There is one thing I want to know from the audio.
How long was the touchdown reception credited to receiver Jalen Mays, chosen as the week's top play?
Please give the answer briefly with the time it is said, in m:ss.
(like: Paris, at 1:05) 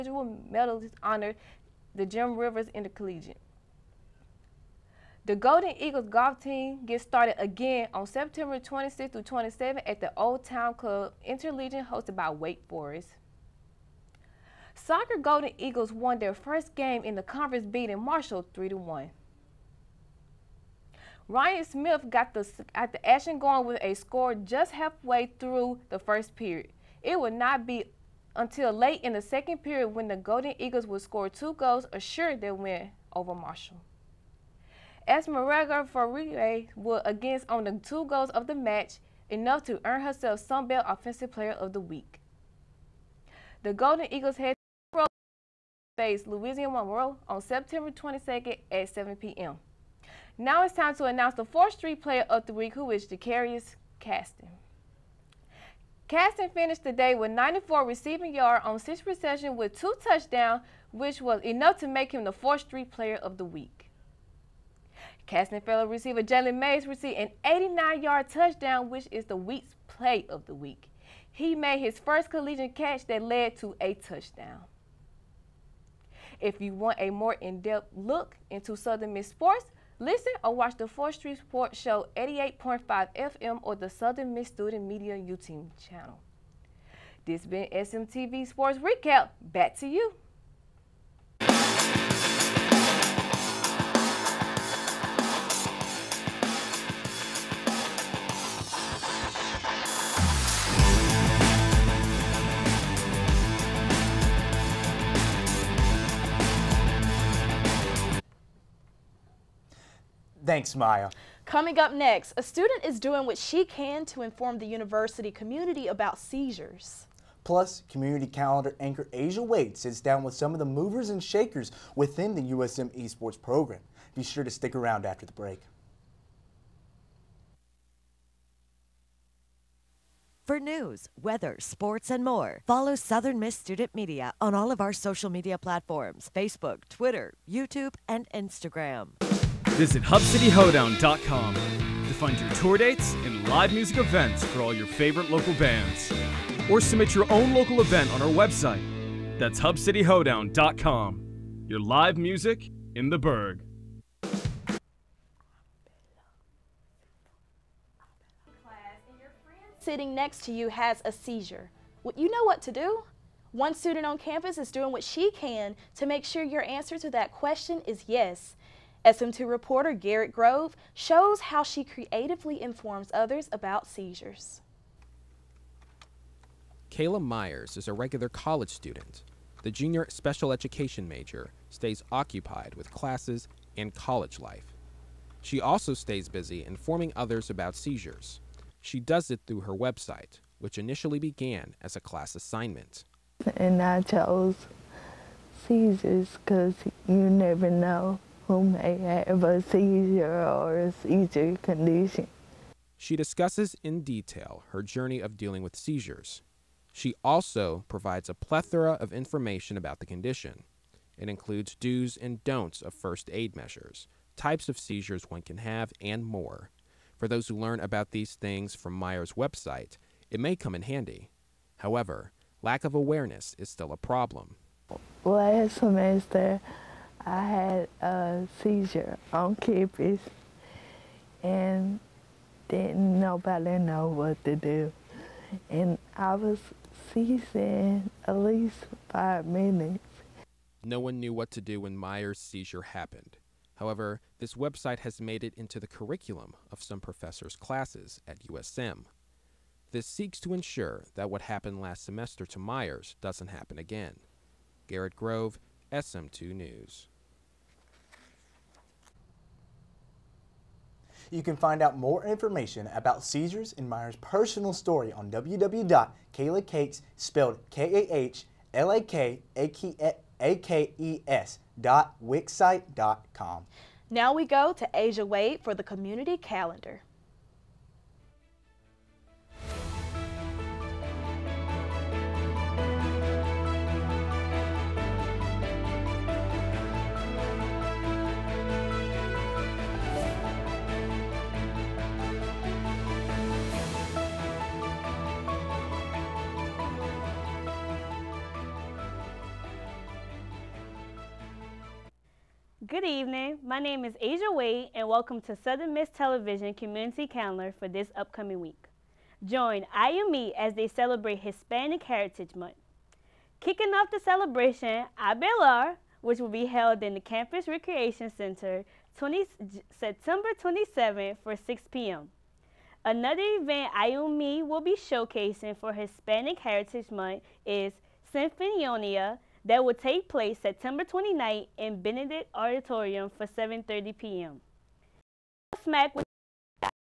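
89 yards, at 1:07.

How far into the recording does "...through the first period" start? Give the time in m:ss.
0:25.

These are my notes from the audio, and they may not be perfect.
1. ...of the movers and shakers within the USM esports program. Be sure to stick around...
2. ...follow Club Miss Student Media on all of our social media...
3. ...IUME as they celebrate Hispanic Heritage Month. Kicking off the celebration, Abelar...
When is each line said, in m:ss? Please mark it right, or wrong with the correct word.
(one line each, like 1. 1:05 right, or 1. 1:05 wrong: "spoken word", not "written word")
1. 2:00 right
2. 2:12 wrong: "Southern", not "Club"
3. 5:09 right.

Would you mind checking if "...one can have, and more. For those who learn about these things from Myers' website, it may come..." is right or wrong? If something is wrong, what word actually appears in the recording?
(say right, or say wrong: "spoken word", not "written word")
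right.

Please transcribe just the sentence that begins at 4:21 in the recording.
You can find out more information about seizures and Myers' personal story on www.kalakakes, spelled K-A-H-L-A-K-A-K-E-S dot wixsite.com.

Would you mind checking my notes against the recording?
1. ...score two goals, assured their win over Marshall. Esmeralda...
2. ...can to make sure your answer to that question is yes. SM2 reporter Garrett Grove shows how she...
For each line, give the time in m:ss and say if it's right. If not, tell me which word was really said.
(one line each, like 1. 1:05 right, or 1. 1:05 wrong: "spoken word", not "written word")
1. 0:31 right
2. 2:45 right.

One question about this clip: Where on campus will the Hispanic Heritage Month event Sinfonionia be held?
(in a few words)
Benedict Auditorium.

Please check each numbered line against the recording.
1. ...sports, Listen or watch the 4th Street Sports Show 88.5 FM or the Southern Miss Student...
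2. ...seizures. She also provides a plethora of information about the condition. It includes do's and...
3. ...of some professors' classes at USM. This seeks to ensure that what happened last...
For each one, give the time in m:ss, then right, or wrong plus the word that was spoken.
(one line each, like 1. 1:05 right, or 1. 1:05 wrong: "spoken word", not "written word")
1. 1:19 right
2. 3:25 right
3. 4:06 right.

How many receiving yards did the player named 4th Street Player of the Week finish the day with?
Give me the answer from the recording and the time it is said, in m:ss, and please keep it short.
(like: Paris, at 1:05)
94, at 0:57.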